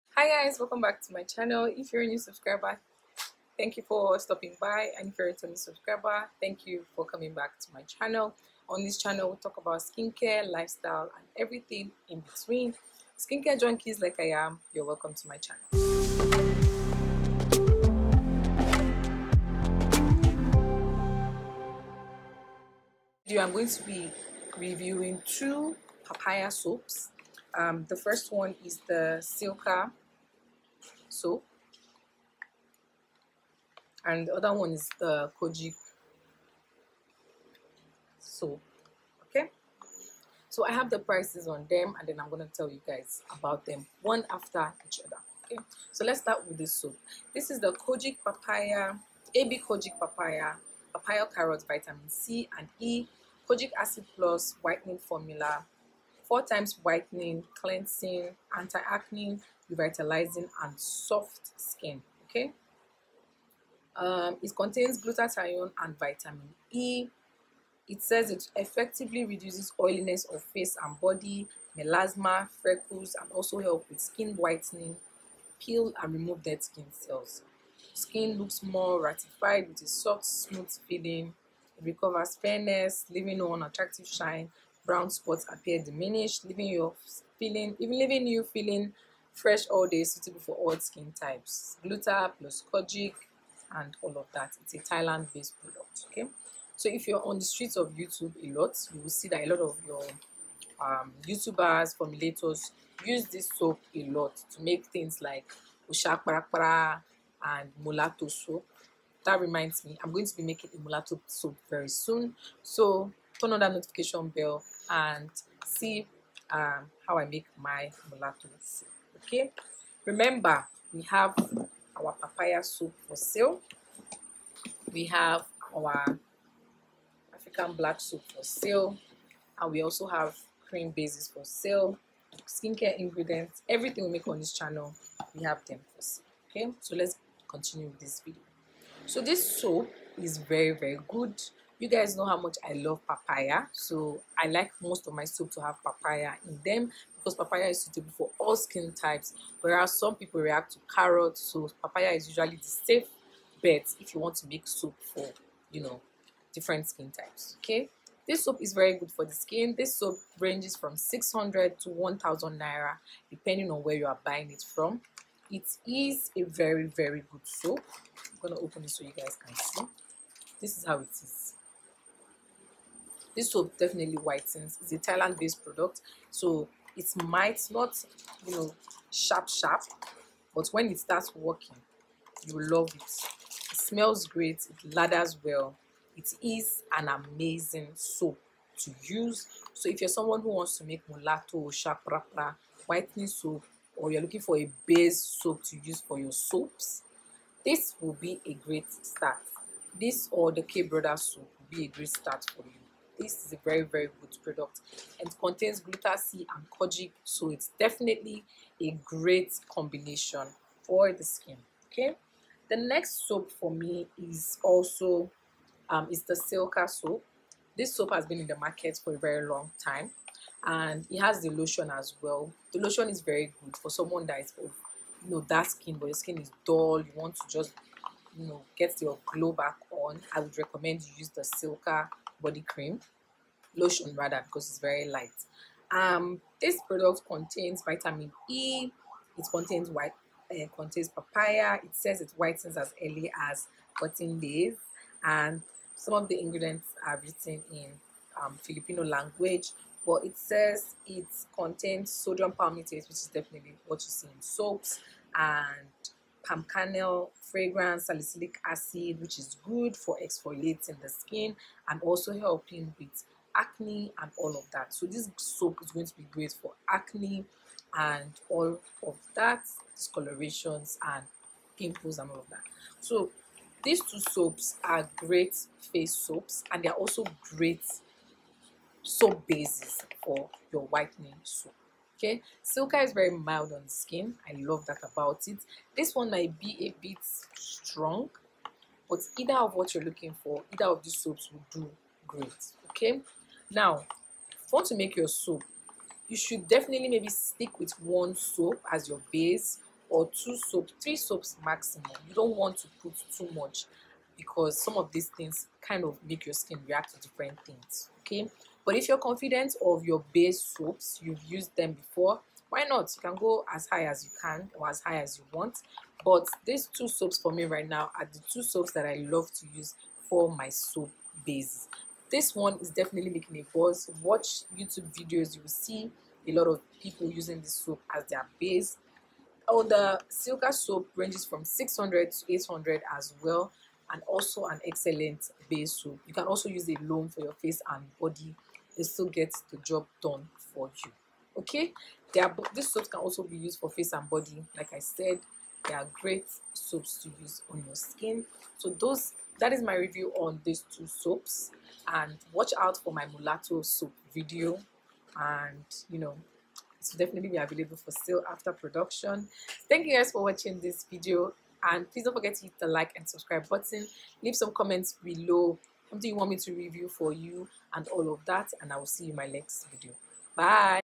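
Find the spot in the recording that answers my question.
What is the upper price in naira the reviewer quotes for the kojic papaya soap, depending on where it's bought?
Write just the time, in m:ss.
2:41.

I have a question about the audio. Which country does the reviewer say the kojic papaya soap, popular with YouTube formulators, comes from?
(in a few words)
Thailand.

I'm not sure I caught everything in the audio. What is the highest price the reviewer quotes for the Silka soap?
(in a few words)
800.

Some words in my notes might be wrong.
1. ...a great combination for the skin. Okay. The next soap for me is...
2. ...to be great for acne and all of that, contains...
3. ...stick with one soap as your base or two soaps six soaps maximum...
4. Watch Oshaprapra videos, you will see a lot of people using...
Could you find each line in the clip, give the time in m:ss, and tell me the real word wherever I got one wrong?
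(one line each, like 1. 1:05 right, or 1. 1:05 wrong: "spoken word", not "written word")
1. 3:28 right
2. 4:26 wrong: "discolorations", not "contains"
3. 4:57 wrong: "three", not "six"
4. 5:24 wrong: "YouTube", not "Oshaprapra".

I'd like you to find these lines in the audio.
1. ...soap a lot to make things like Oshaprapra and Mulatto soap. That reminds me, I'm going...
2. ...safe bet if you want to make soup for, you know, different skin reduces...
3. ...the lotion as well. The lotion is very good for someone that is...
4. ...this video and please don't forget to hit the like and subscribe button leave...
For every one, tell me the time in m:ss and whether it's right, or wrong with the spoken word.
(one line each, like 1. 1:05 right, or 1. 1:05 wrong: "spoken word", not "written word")
1. 1:43 right
2. 2:32 wrong: "types", not "reduces"
3. 3:41 right
4. 6:00 right.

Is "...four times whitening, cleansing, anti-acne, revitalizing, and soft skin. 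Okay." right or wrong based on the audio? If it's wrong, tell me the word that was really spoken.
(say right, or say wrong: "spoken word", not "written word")
right.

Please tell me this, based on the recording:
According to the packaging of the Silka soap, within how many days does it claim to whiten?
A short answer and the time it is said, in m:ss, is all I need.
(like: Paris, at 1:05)
14 days, at 4:03.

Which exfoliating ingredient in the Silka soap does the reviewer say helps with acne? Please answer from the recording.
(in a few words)
Salicylic acid.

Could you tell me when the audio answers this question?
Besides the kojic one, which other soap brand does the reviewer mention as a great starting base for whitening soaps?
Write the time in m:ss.
3:20.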